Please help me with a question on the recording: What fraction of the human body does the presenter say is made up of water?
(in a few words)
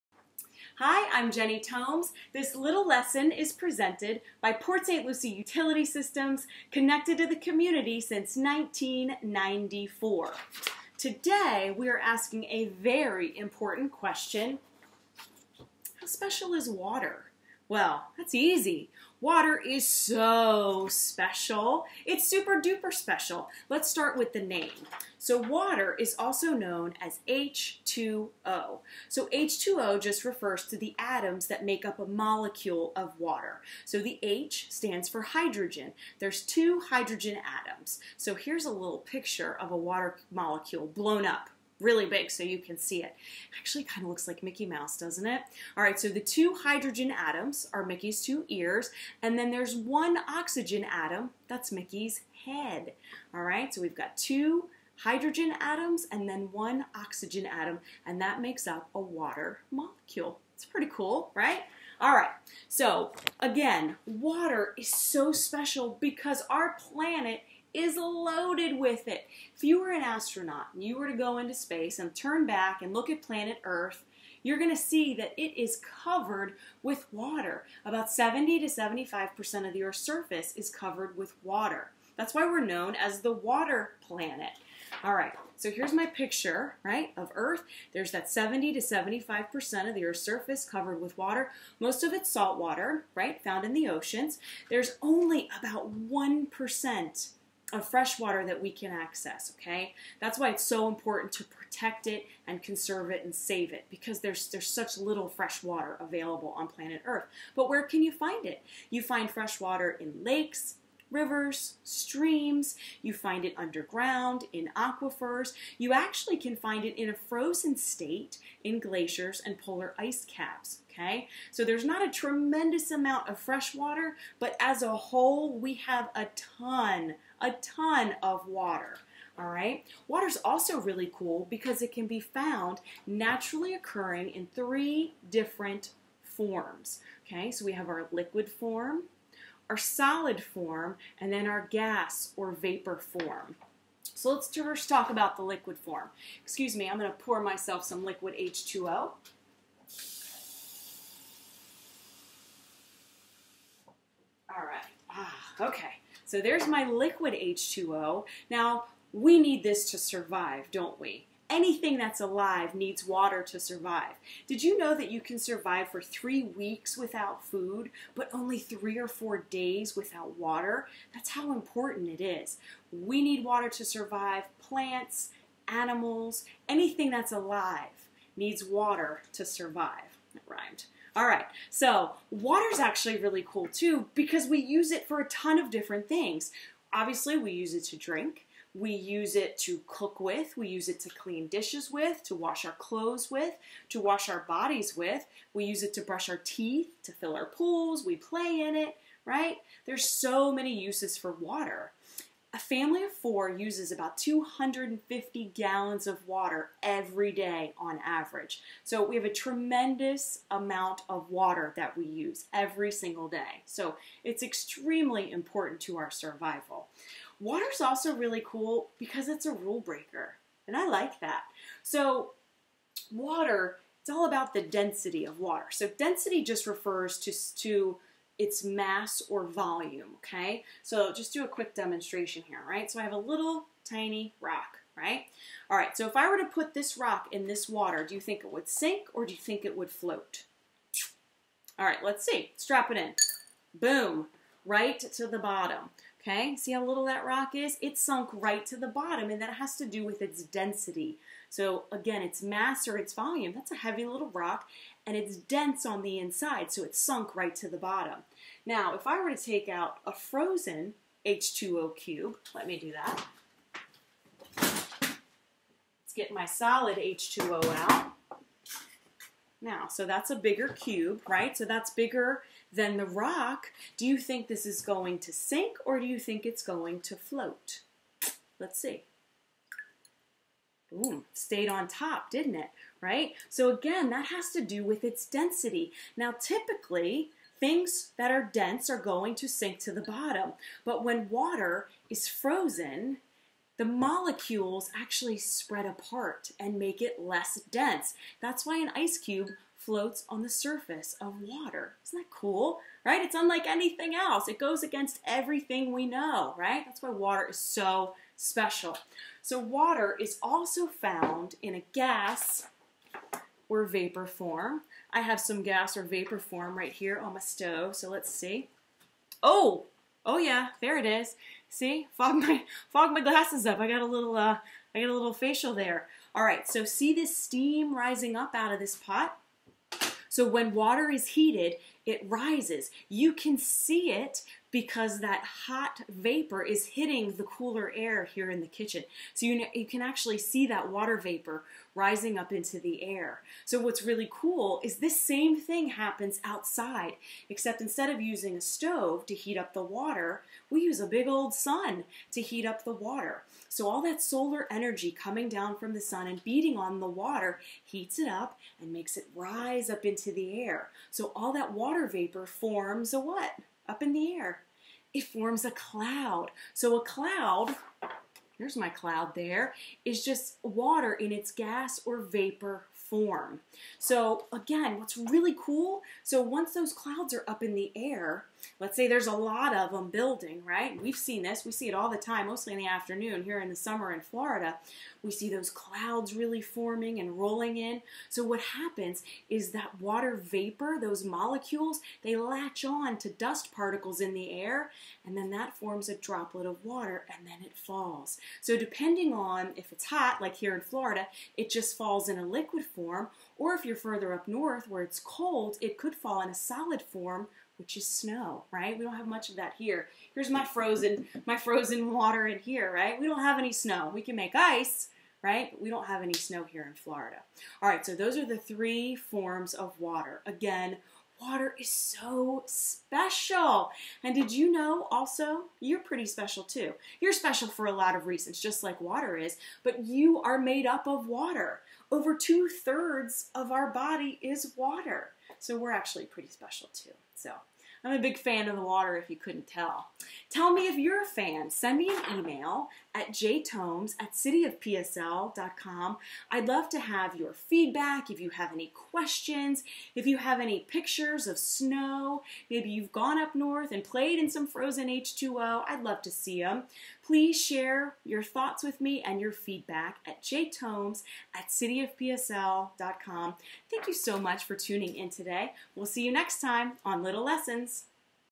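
Over two thirds.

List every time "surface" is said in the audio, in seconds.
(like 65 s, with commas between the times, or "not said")
79 s, 90 s, 300 s.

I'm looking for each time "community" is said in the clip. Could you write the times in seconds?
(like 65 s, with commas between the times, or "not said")
7 s.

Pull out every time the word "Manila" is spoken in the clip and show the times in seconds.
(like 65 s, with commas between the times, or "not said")
not said.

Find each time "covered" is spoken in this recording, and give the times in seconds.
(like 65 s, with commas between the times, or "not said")
76 s, 80 s, 90 s.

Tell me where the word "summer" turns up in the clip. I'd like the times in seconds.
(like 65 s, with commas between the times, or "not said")
383 s.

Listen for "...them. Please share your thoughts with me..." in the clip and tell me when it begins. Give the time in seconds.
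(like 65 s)
456 s.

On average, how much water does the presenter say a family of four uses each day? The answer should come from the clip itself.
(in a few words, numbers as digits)
250 gallons.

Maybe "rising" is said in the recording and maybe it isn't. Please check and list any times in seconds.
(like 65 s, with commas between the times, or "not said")
327 s, 341 s.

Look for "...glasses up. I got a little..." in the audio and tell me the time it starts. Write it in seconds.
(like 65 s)
323 s.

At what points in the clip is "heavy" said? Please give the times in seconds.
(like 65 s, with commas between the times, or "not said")
253 s.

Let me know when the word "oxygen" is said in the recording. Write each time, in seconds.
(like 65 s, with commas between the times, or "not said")
50 s, 56 s.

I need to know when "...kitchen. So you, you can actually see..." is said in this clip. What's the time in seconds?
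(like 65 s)
338 s.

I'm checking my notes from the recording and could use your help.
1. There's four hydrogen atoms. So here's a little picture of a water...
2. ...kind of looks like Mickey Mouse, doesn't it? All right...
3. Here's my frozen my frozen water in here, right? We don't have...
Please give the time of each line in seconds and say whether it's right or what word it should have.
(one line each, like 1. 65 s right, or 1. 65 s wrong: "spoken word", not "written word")
1. 36 s wrong: "two", not "four"
2. 43 s right
3. 410 s right.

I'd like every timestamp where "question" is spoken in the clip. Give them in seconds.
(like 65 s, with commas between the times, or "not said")
13 s, 448 s.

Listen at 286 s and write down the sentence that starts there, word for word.
Now, typically, things that are dense are going to sink to the bottom.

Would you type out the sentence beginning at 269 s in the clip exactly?
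Now, so that's a bigger cube, right?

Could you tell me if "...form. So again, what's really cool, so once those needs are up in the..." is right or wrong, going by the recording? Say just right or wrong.
wrong.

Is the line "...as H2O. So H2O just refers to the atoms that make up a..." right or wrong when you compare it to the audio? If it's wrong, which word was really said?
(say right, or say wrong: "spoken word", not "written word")
right.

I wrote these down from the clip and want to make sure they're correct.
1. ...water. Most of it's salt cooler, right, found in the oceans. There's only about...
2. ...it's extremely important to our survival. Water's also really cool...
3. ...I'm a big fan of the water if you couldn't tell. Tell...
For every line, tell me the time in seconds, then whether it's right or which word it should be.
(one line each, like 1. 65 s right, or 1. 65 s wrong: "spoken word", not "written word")
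1. 91 s wrong: "water", not "cooler"
2. 214 s right
3. 438 s right.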